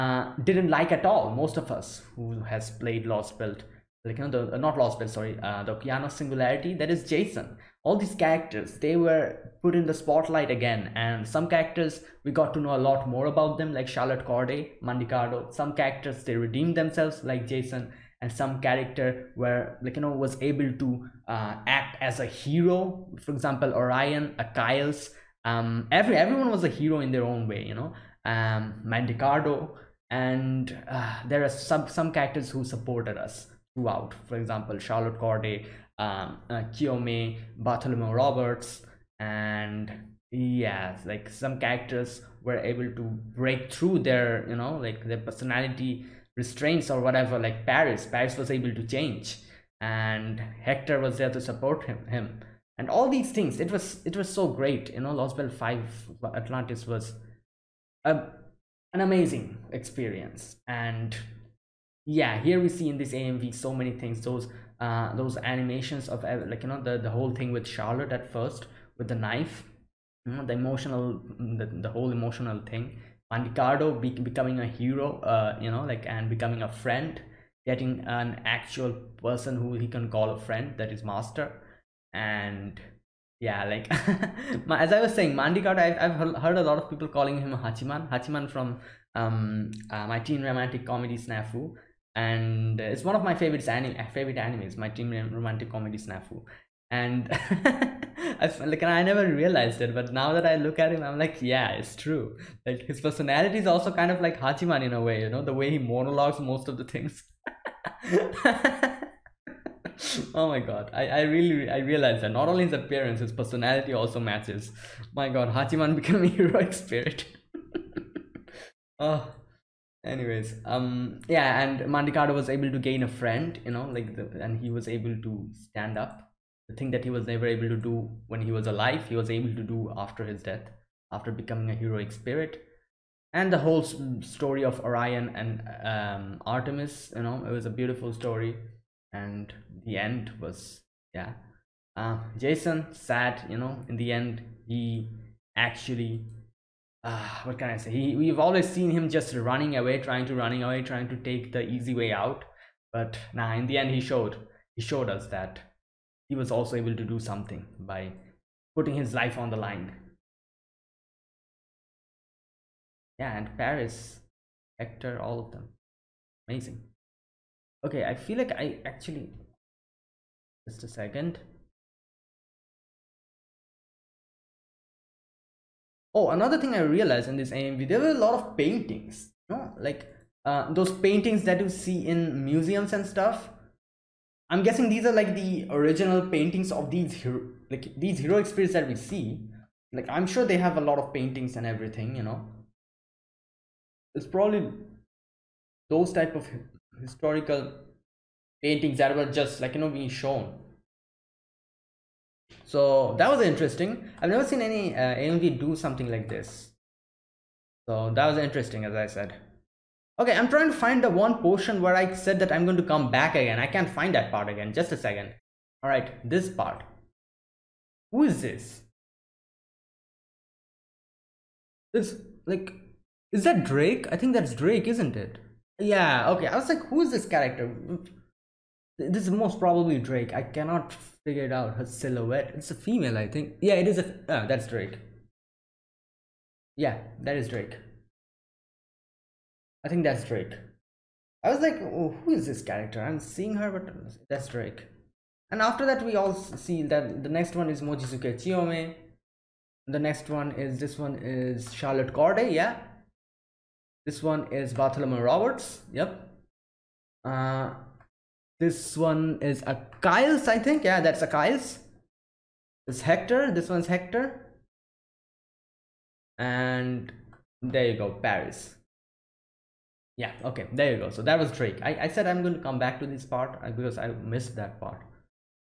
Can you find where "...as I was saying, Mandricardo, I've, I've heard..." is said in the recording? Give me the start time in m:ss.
1:24.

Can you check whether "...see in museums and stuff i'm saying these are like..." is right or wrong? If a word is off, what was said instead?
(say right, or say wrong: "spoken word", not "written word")
wrong: "guessing", not "saying".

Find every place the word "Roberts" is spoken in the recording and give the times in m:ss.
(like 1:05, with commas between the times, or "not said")
0:38, 4:15.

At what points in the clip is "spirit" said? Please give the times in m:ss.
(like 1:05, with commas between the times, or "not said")
1:56, 2:12, 3:08.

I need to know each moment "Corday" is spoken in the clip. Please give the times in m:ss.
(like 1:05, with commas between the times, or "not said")
0:14, 0:35, 4:12.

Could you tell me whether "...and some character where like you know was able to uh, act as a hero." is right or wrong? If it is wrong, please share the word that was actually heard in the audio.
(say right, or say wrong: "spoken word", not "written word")
right.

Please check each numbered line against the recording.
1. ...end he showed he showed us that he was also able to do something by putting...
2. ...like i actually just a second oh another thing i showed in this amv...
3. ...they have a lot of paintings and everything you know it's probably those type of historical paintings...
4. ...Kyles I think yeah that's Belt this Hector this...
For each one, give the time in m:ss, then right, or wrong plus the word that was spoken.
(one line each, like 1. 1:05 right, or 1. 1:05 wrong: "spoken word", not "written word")
1. 2:33 right
2. 2:48 wrong: "realized", not "showed"
3. 3:10 right
4. 4:20 wrong: "Achilles", not "Belt".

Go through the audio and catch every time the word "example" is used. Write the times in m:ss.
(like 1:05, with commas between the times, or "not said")
0:23, 0:34.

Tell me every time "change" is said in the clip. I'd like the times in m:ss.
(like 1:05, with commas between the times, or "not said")
0:48.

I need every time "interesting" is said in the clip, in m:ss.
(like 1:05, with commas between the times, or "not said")
3:23, 3:28.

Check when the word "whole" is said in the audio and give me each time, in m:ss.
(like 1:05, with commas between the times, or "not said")
1:07, 1:11, 2:13.